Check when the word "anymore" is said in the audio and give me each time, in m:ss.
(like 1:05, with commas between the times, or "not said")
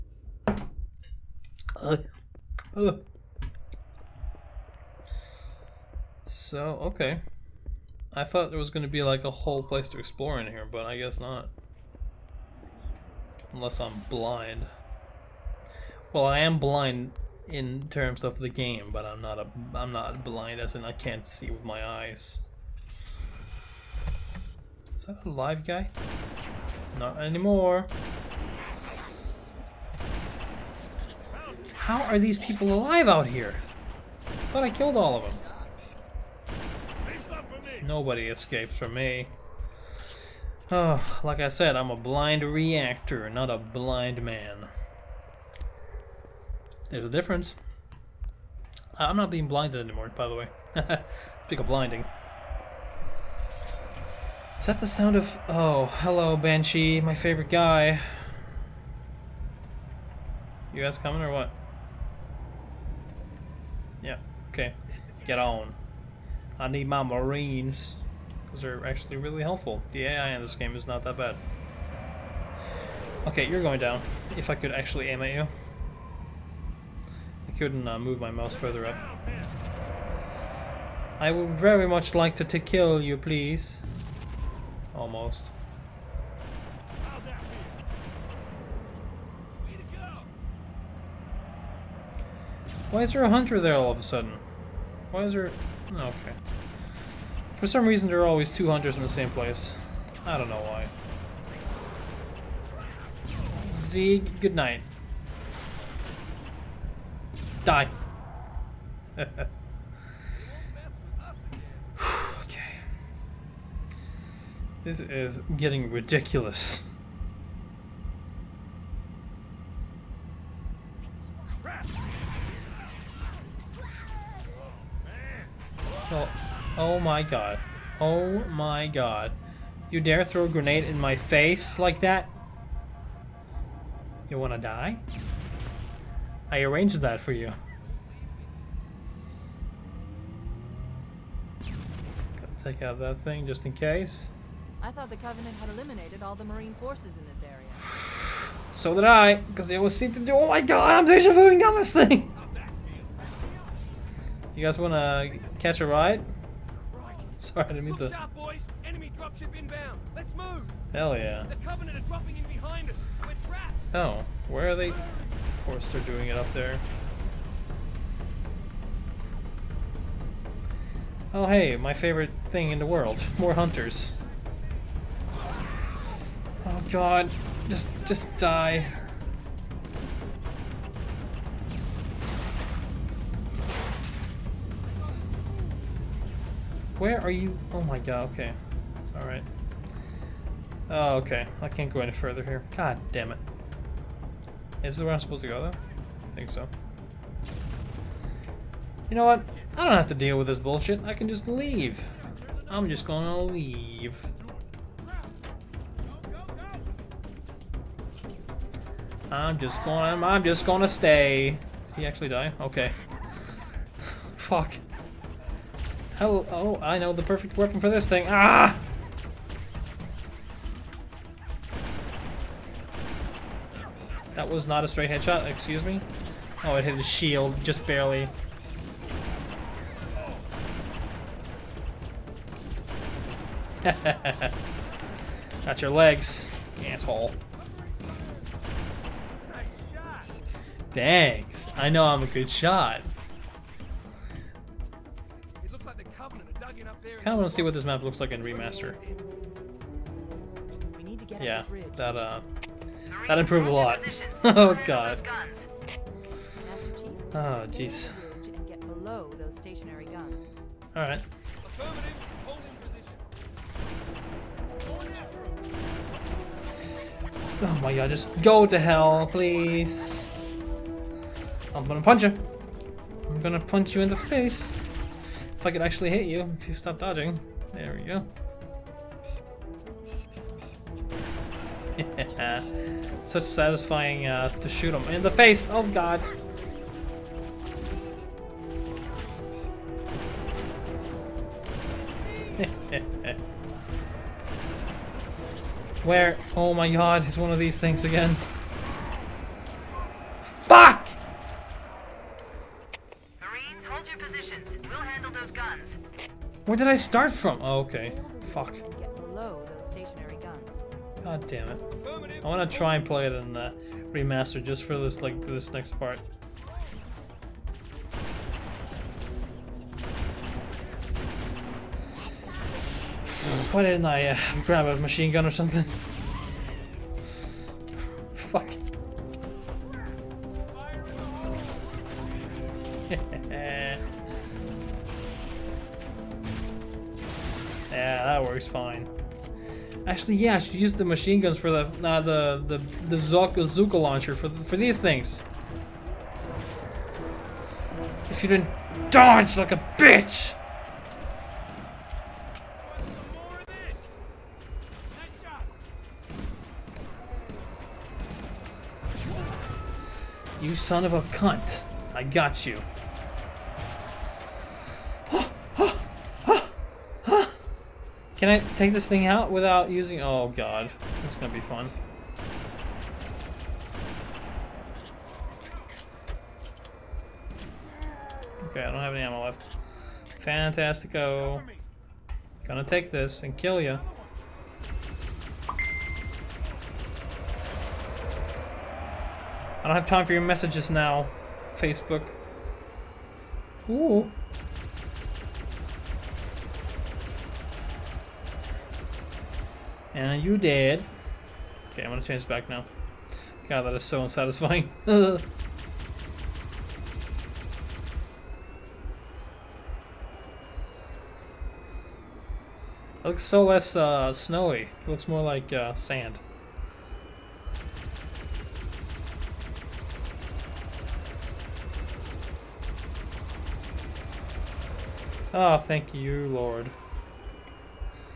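0:27, 0:49.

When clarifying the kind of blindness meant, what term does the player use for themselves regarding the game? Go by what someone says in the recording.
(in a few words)
blind reactor.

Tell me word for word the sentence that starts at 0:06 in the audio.
So okay, I thought there was going to be like a whole place to explore in here, but I guess not.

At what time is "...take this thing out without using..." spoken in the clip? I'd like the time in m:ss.
6:08.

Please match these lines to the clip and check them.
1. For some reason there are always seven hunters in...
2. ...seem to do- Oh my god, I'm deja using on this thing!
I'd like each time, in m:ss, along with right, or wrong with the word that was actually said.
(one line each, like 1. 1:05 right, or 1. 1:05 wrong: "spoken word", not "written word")
1. 1:37 wrong: "two", not "seven"
2. 2:29 wrong: "vuing", not "using".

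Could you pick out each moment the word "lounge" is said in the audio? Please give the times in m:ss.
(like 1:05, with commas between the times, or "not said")
not said.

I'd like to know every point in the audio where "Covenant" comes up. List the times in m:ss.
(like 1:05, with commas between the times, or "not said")
2:25, 2:41.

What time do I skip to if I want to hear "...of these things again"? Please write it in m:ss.
4:57.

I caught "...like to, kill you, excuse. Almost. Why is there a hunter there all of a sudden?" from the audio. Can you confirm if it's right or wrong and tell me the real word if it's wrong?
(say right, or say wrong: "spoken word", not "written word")
wrong: "please", not "excuse".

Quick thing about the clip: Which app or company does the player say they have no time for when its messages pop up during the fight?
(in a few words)
Facebook.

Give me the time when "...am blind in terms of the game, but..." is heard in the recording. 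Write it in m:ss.
0:16.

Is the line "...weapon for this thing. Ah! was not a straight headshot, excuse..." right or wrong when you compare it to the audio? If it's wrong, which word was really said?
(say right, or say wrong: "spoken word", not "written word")
right.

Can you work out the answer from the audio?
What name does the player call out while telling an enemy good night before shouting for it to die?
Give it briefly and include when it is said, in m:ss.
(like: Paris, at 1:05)
Zeke, at 1:43.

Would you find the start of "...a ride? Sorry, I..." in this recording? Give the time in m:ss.
2:35.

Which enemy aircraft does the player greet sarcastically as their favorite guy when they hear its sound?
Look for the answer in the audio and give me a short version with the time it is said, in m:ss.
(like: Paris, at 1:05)
Banshee, at 0:56.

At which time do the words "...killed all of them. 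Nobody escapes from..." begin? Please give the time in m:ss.
0:34.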